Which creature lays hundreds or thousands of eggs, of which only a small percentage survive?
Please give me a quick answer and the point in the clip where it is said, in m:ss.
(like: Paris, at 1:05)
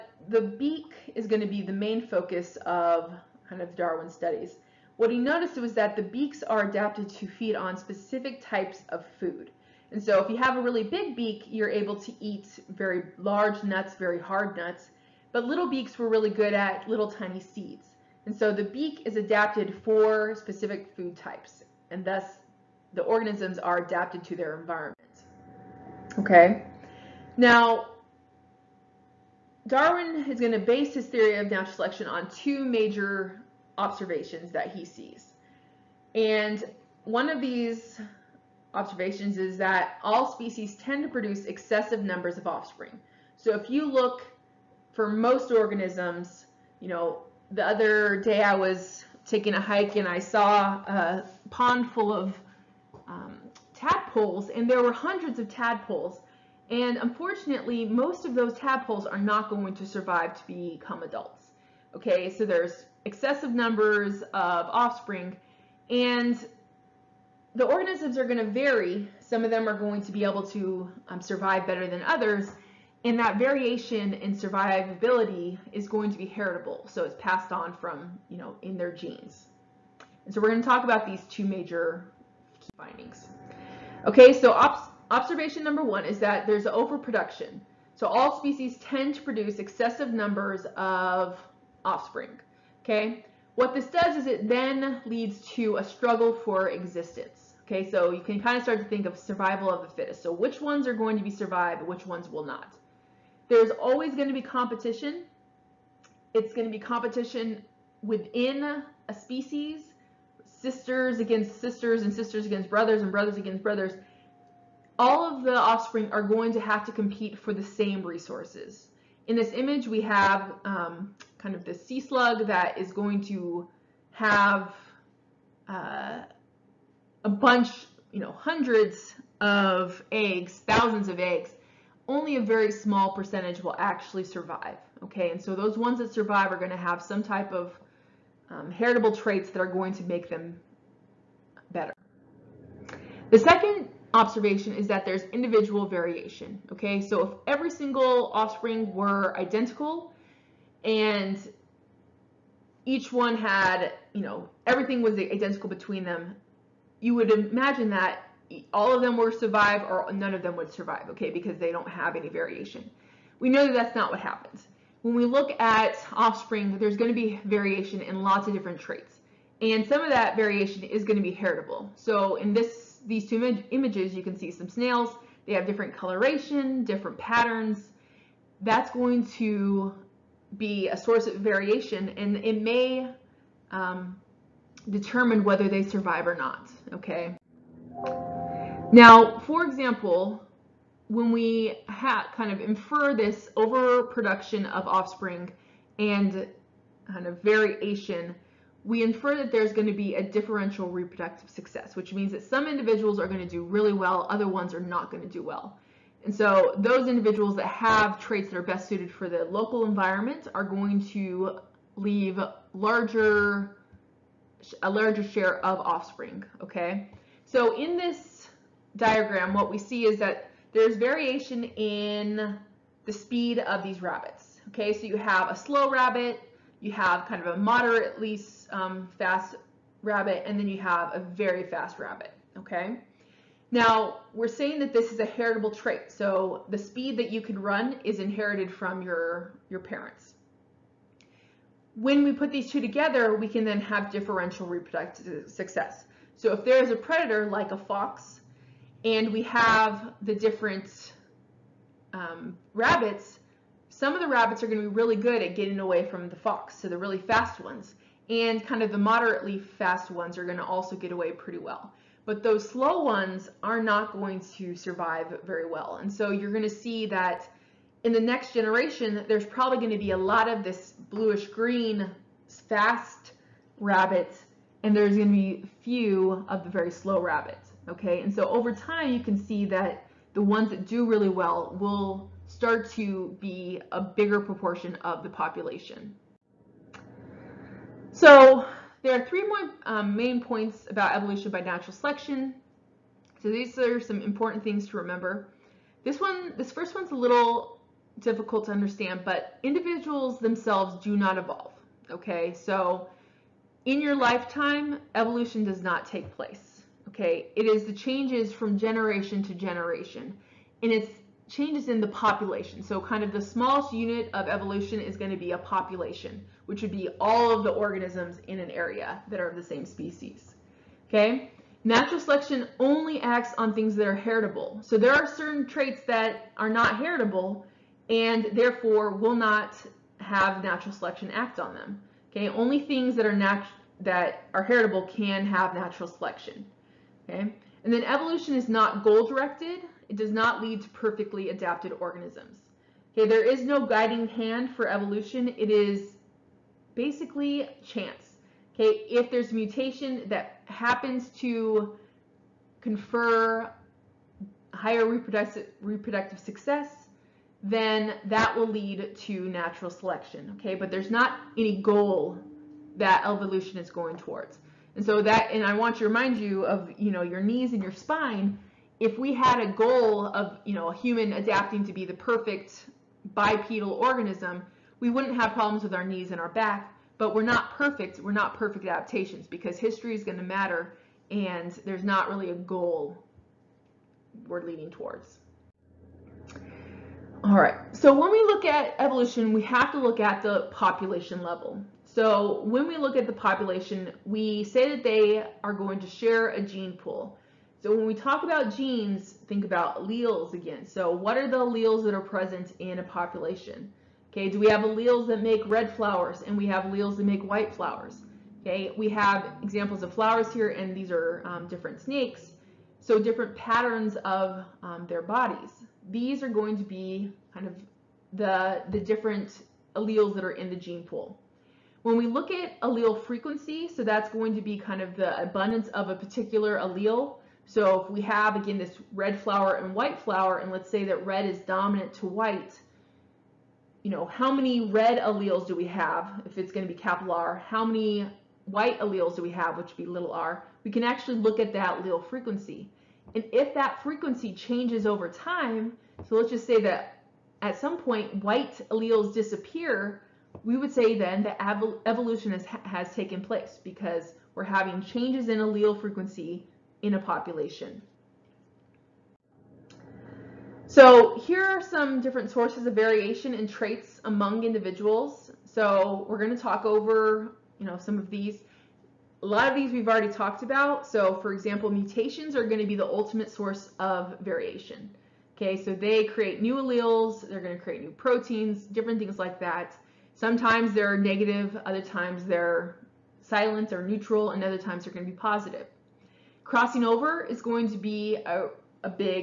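Sea slug, at 2:01.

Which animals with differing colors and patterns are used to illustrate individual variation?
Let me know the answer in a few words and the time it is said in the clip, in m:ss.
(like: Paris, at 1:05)
Snails, at 2:54.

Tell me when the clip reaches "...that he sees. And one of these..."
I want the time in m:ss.
0:34.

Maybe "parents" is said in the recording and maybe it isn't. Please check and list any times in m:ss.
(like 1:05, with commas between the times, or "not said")
3:59.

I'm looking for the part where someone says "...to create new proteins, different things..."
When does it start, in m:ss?
7:57.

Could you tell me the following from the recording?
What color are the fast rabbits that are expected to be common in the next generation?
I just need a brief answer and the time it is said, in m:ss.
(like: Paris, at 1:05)
Bluish green, at 4:31.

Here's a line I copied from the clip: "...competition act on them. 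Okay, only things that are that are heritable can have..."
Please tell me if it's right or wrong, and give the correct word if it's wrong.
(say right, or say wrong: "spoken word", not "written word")
wrong: "selection", not "competition".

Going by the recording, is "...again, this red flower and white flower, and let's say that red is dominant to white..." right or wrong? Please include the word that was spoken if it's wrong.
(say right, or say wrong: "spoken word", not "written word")
right.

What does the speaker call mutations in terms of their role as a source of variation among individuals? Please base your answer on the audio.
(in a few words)
The ultimate source.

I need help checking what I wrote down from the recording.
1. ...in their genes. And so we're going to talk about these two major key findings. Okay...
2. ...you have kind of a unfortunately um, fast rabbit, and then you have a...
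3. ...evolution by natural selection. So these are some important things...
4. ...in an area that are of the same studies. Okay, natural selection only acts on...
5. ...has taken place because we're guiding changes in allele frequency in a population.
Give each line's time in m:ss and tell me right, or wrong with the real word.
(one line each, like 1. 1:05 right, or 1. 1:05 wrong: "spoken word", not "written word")
1. 1:18 right
2. 3:46 wrong: "moderately", not "unfortunately"
3. 4:51 right
4. 5:18 wrong: "species", not "studies"
5. 7:32 wrong: "having", not "guiding".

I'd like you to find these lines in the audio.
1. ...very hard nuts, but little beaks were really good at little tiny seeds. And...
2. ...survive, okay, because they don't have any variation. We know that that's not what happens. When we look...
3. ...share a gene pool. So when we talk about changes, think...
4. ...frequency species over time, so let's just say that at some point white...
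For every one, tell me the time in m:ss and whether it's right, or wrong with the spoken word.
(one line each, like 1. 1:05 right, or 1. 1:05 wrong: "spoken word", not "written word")
1. 0:13 right
2. 2:40 right
3. 6:36 wrong: "genes", not "changes"
4. 7:24 wrong: "changes", not "species".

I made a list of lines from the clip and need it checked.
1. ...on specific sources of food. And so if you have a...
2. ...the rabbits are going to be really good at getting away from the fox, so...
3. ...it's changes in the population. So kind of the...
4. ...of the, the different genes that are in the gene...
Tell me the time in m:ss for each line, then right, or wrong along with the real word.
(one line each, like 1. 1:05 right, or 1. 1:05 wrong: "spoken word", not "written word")
1. 0:07 wrong: "types", not "sources"
2. 4:14 right
3. 5:10 right
4. 6:57 wrong: "alleles", not "genes".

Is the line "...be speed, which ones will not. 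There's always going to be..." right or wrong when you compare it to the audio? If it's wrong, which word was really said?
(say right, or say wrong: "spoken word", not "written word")
wrong: "survived", not "speed".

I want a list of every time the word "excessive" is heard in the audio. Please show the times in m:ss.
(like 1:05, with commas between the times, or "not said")
0:41, 1:03, 1:29.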